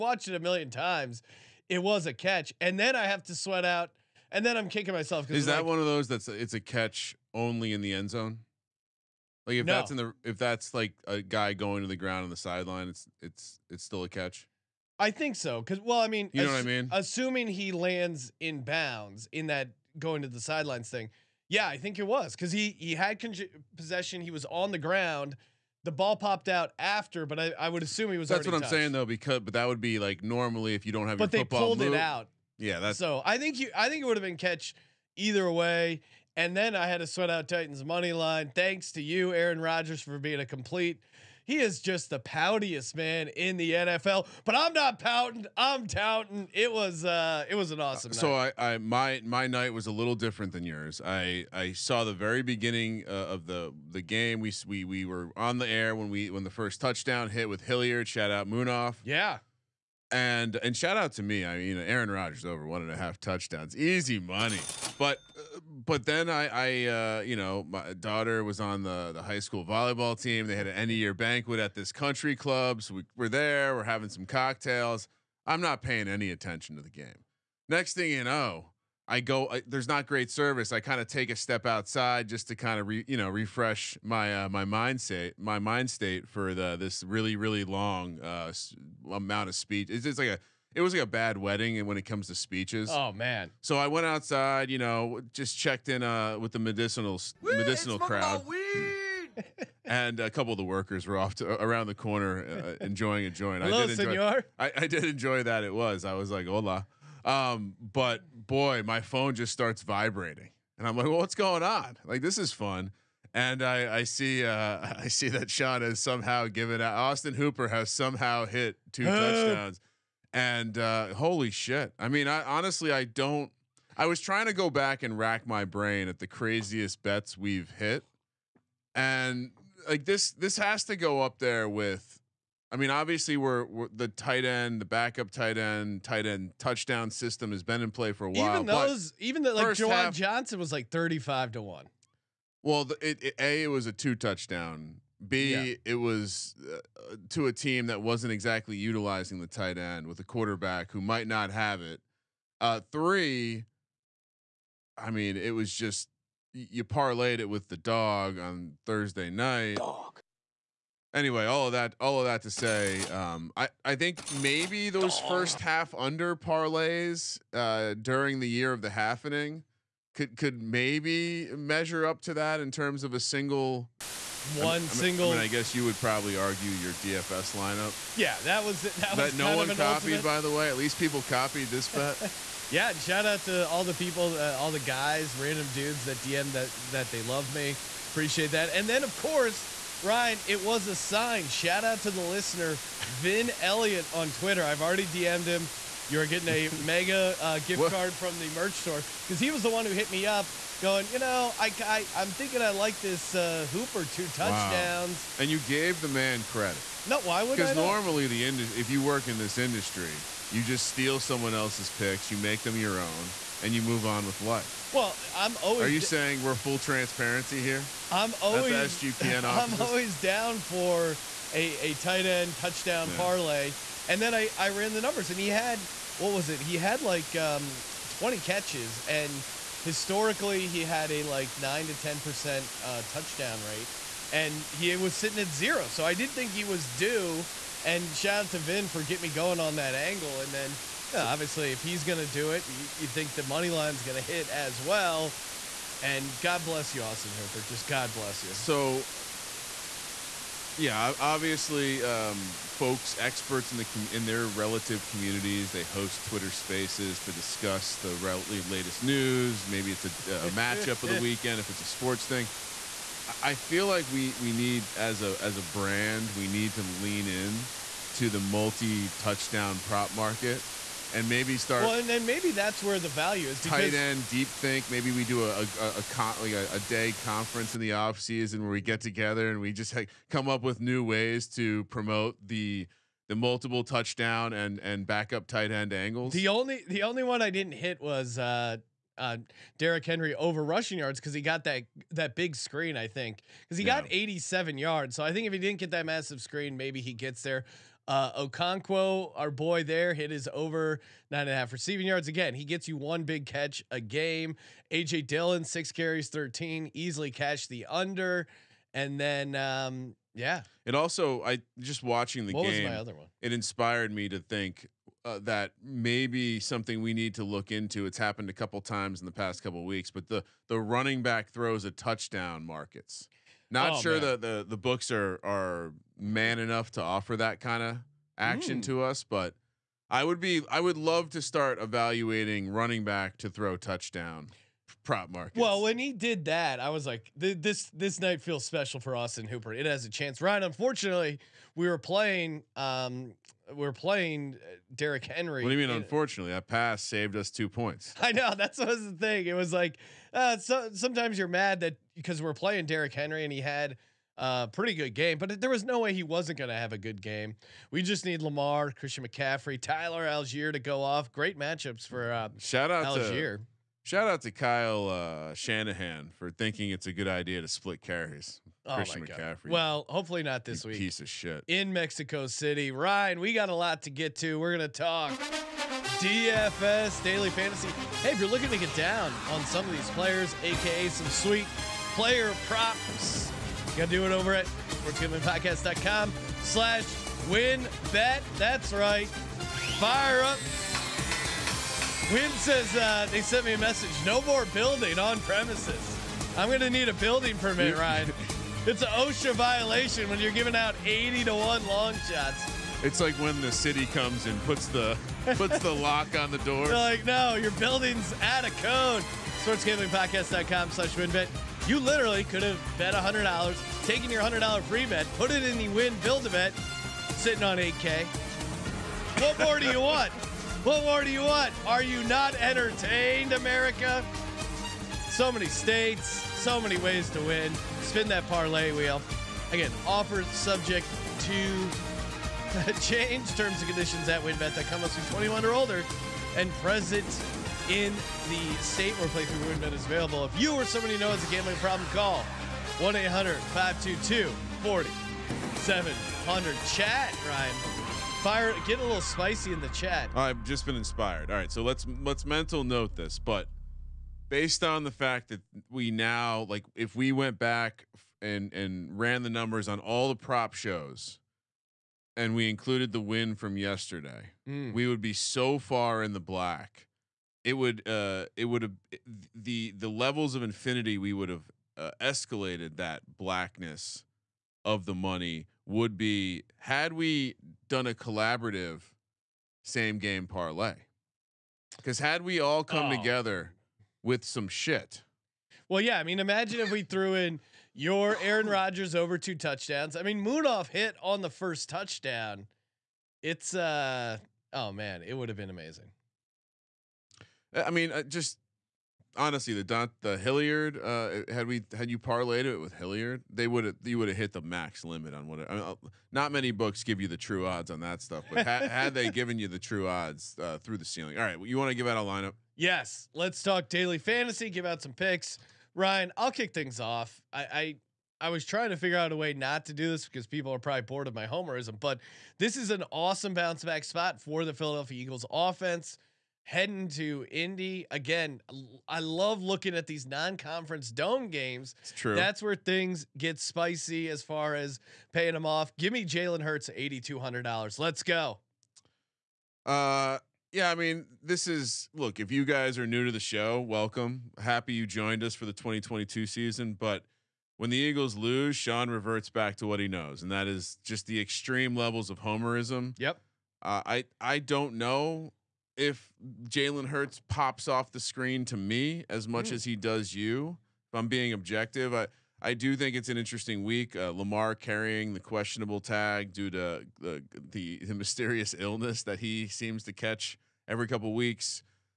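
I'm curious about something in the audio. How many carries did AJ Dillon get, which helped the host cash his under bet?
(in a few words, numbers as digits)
6.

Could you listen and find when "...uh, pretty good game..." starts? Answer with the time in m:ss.
5:54.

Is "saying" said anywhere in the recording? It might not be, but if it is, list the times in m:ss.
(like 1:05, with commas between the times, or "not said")
0:28, 3:35.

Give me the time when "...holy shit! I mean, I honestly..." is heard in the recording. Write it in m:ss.
2:01.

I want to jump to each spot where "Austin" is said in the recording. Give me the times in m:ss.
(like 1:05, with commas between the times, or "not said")
1:56, 4:07, 5:39.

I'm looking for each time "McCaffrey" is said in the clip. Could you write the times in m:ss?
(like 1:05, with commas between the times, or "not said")
5:59, 6:09.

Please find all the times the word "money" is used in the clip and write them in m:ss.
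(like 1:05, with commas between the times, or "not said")
0:37, 1:04, 4:03, 7:55.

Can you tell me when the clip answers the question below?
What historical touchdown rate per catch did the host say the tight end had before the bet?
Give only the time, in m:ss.
3:51.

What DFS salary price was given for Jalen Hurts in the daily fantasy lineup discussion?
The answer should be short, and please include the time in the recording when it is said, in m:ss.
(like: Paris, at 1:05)
$8,200, at 8:56.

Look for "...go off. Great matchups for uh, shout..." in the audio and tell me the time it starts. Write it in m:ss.
6:00.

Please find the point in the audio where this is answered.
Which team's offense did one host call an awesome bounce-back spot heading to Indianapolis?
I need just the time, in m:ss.
8:44.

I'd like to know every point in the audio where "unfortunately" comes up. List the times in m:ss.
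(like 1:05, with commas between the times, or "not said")
5:40, 5:45.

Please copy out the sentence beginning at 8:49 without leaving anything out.
I love looking at these non-conference dome games.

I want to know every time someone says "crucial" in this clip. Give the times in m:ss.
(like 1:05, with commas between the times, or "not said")
not said.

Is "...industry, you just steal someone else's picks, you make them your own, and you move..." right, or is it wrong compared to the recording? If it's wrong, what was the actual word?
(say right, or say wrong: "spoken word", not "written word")
right.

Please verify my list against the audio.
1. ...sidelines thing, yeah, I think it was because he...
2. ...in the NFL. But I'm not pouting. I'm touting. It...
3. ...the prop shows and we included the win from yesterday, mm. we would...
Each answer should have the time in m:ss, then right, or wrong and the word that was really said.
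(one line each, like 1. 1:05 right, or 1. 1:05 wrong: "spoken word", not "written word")
1. 0:20 right
2. 0:43 right
3. 7:40 right.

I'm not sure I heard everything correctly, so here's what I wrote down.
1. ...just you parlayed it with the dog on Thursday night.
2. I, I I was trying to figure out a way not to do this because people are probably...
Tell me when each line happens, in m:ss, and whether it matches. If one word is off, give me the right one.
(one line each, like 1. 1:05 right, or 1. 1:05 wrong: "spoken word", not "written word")
1. 2:35 right
2. 8:37 right.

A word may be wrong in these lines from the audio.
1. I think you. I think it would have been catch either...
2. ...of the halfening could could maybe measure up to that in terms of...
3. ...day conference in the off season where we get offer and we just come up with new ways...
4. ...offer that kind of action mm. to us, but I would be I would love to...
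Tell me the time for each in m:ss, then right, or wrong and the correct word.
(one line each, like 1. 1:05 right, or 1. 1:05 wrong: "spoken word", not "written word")
1. 0:33 right
2. 2:48 right
3. 4:36 wrong: "together", not "offer"
4. 5:27 right.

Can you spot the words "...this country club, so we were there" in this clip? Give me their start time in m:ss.
1:11.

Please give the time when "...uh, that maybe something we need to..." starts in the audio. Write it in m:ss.
5:15.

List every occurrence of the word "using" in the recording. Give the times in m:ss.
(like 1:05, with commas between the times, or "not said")
not said.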